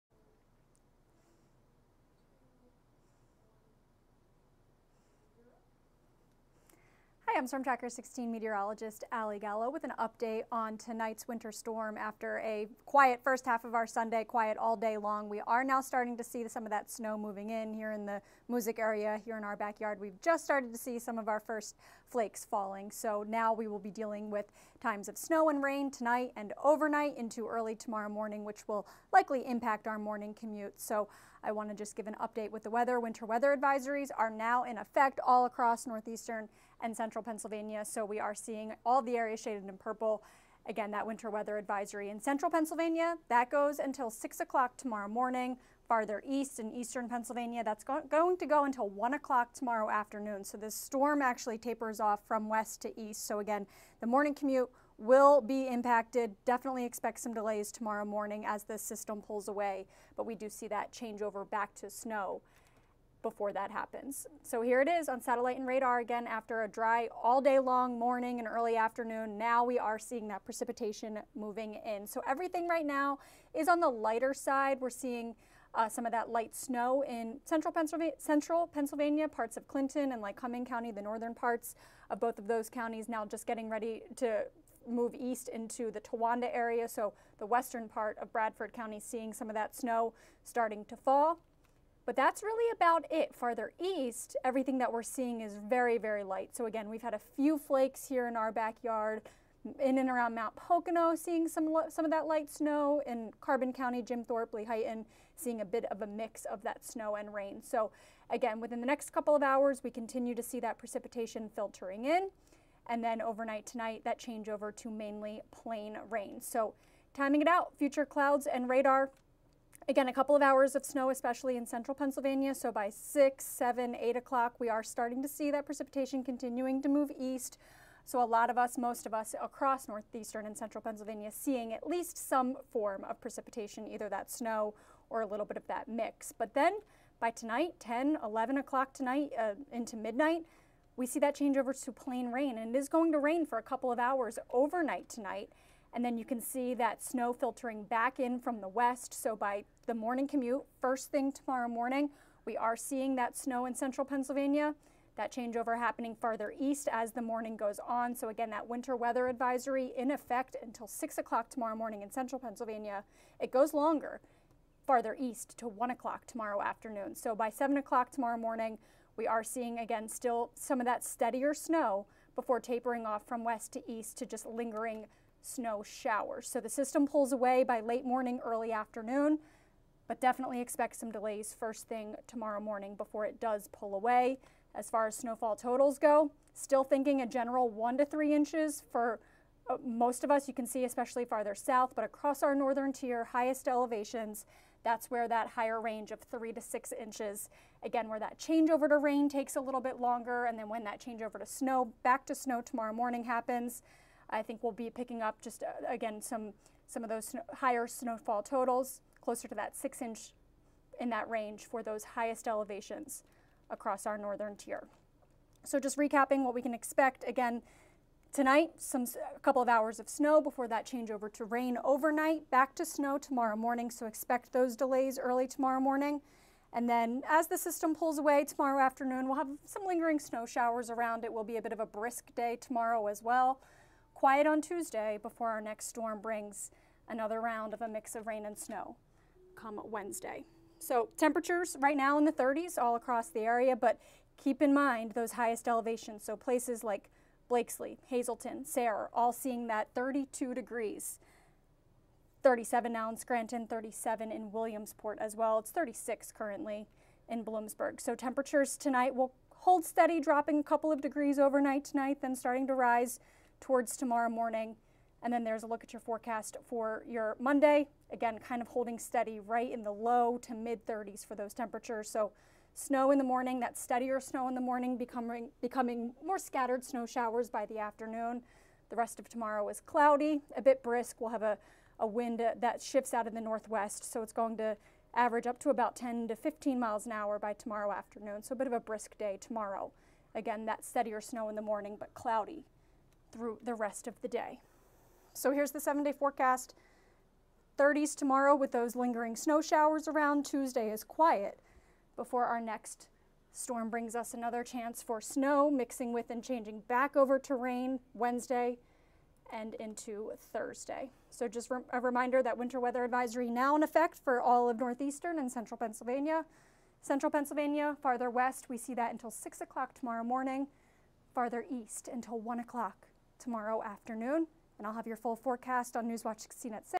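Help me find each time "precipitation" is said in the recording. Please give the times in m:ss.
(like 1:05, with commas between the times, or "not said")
1:10, 1:50, 2:05, 2:13.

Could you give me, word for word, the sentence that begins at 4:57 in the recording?
30s tomorrow with those lingering snow showers around.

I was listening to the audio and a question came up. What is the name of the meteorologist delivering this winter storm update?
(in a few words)
Ally Gallo.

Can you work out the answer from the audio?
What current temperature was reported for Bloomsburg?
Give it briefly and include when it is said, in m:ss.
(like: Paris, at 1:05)
36, at 4:15.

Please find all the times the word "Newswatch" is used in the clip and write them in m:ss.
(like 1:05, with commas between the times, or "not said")
5:26.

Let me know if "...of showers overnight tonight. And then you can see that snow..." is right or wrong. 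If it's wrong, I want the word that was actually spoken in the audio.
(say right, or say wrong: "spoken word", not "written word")
wrong: "hours", not "showers".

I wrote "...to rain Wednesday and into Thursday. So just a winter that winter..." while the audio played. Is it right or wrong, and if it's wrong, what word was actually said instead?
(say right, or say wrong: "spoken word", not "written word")
wrong: "reminder", not "winter".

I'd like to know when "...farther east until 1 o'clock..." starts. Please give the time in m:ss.
5:21.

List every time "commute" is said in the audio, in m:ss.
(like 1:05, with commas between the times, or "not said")
0:30, 0:54, 2:30.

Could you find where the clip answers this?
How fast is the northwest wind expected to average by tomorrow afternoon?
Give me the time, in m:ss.
4:45.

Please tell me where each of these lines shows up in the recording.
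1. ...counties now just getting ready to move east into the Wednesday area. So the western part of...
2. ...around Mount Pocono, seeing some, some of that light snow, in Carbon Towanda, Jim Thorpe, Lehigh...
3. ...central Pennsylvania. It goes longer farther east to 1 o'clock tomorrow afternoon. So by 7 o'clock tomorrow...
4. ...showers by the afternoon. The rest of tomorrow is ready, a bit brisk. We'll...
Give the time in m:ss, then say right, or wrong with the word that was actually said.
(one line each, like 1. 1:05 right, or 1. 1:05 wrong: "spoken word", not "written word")
1. 1:22 wrong: "Towanda", not "Wednesday"
2. 1:40 wrong: "County", not "Towanda"
3. 2:42 right
4. 4:37 wrong: "cloudy", not "ready".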